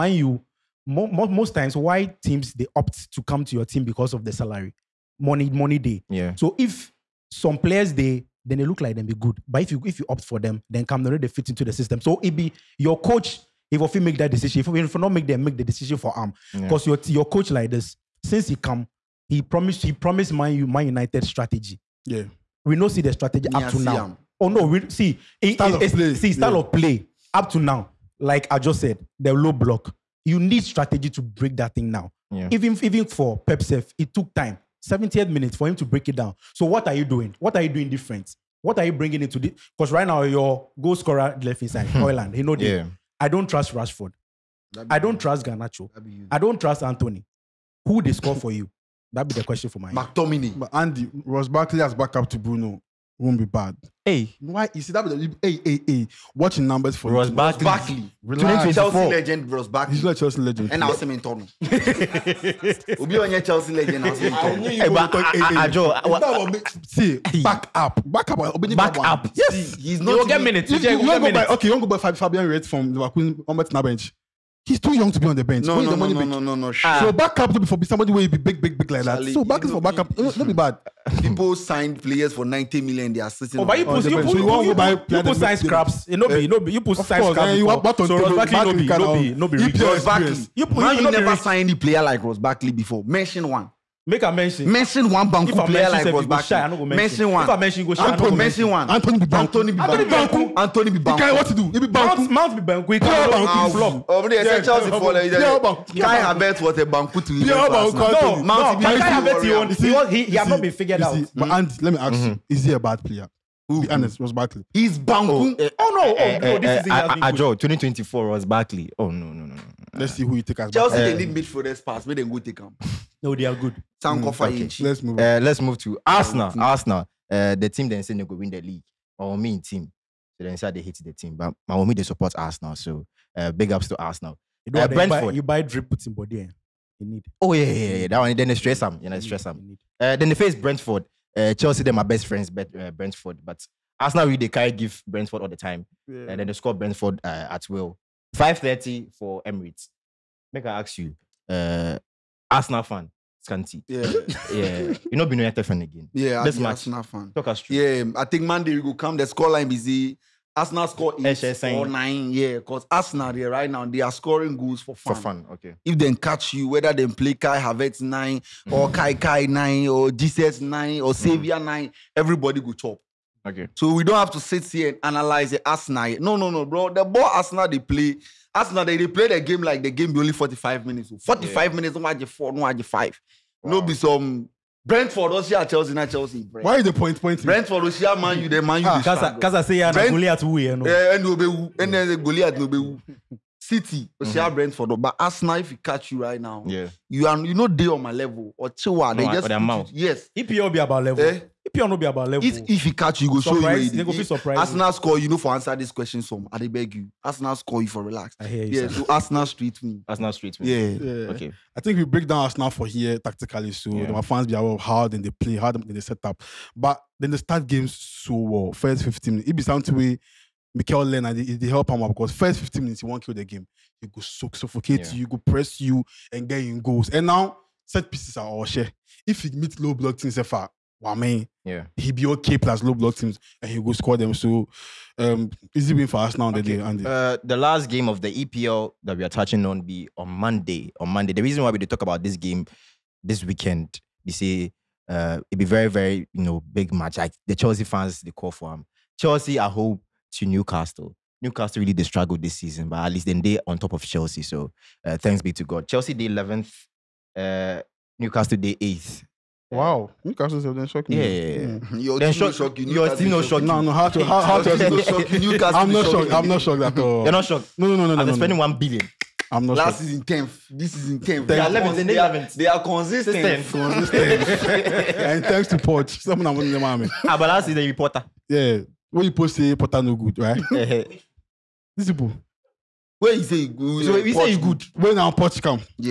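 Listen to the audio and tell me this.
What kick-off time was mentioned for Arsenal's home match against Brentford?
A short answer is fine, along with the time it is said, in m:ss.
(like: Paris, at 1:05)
5.30, at 2:28.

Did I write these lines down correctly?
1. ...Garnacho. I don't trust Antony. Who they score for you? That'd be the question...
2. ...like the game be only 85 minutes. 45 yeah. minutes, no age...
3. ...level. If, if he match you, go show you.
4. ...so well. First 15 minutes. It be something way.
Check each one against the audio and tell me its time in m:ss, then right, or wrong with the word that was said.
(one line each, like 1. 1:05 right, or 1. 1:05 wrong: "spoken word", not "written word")
1. 0:45 right
2. 2:59 wrong: "45", not "85"
3. 3:22 wrong: "catch", not "match"
4. 3:37 right.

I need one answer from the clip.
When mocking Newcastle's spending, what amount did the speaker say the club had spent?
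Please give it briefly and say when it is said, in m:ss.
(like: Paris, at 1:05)
1 billion, at 4:28.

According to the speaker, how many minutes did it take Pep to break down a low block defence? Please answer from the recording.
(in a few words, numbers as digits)
78.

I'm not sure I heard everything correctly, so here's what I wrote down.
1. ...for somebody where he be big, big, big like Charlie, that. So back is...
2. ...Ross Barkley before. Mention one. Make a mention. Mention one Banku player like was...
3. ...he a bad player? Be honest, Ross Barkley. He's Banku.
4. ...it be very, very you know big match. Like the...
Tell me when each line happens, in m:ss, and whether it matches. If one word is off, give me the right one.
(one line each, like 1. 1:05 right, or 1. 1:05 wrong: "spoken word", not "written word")
1. 1:17 right
2. 1:32 right
3. 1:52 right
4. 4:05 right.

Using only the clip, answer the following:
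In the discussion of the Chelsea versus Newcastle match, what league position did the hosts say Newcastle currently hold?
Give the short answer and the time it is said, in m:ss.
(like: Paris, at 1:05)
8th, at 4:18.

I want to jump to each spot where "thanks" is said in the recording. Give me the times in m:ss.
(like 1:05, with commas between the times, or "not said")
4:15, 4:35.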